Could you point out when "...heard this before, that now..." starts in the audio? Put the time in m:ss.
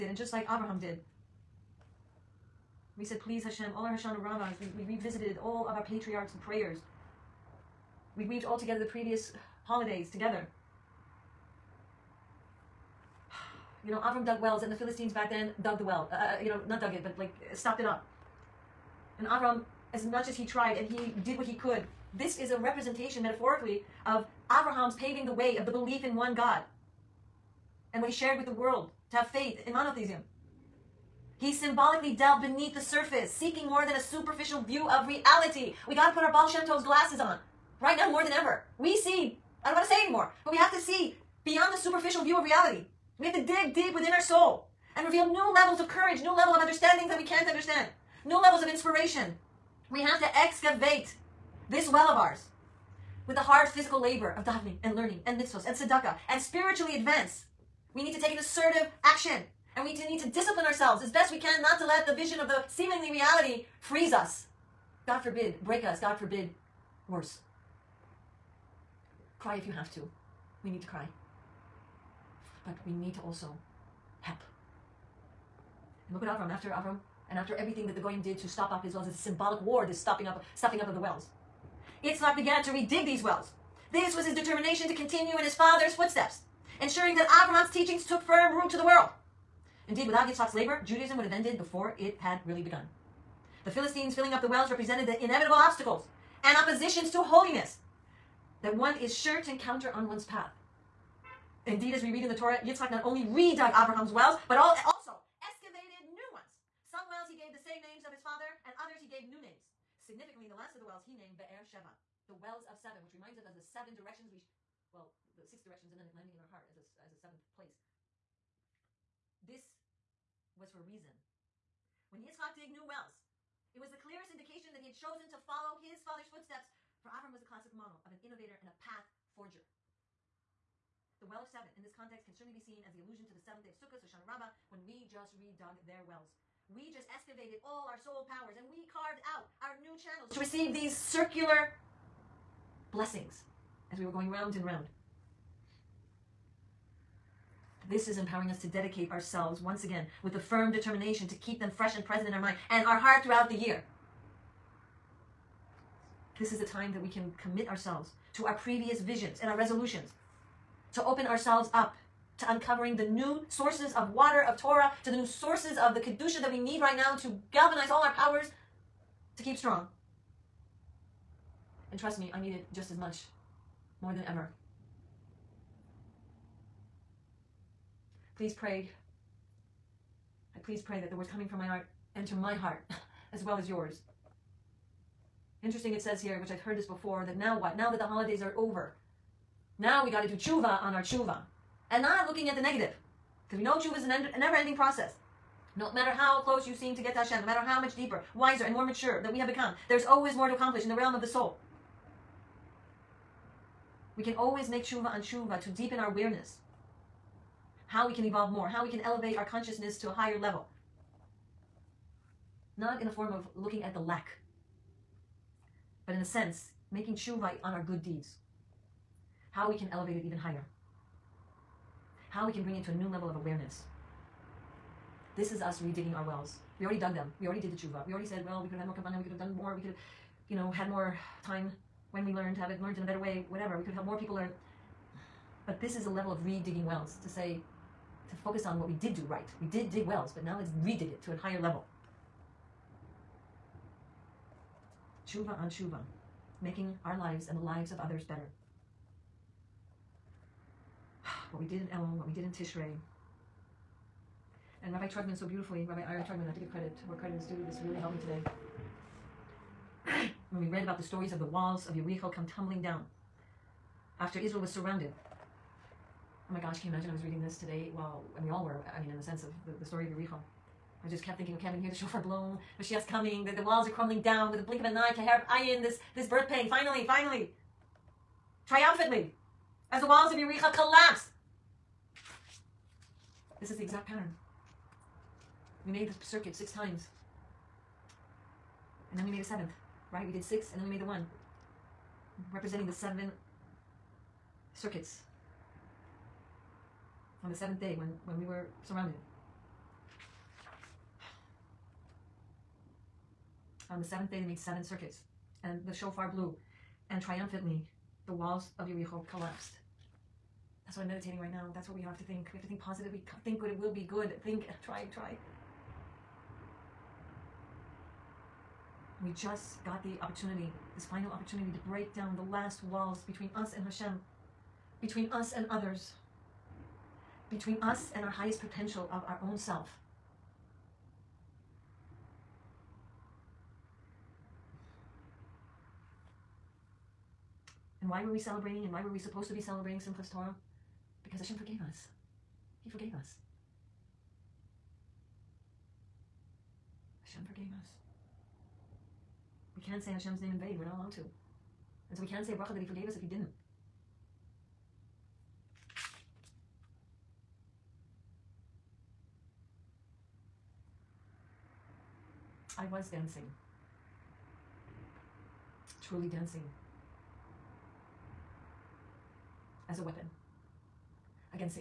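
3:06.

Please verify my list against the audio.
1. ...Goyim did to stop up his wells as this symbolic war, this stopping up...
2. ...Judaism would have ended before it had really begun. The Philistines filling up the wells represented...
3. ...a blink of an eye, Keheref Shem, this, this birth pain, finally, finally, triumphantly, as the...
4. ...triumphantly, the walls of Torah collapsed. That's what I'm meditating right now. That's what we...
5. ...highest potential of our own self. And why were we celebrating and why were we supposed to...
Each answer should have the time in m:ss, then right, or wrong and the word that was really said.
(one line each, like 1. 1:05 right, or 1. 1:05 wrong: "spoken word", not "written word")
1. 1:17 right
2. 1:30 right
3. 4:34 wrong: "Ayin", not "Shem"
4. 5:07 wrong: "Yericho", not "Torah"
5. 5:28 right.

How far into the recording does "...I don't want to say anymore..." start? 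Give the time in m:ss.
0:39.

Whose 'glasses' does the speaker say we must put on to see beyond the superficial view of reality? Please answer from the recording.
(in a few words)
Baal Shem Tov.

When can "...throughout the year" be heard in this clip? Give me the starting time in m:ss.
2:33.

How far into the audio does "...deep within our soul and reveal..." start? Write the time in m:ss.
0:43.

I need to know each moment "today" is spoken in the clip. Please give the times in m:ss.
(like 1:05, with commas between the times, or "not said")
4:18, 4:27.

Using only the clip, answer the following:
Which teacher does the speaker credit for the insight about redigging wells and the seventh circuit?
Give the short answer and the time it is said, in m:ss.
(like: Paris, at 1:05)
Rabbi Ira Trugman, at 4:15.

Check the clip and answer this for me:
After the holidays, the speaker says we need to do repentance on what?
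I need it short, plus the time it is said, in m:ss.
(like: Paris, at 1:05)
On our tshuva, at 3:10.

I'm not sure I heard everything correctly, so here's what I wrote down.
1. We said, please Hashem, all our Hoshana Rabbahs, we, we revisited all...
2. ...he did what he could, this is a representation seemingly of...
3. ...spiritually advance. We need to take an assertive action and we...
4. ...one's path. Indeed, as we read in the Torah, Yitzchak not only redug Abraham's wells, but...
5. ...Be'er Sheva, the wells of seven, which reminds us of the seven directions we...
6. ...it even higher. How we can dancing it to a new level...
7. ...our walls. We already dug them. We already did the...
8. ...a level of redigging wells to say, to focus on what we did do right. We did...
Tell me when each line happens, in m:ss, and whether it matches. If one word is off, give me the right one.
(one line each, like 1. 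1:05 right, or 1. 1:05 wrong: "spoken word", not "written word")
1. 0:02 right
2. 0:20 wrong: "metaphorically", not "seemingly"
3. 0:56 right
4. 1:40 right
5. 1:51 right
6. 3:40 wrong: "bring", not "dancing"
7. 3:46 wrong: "wells", not "walls"
8. 3:56 right.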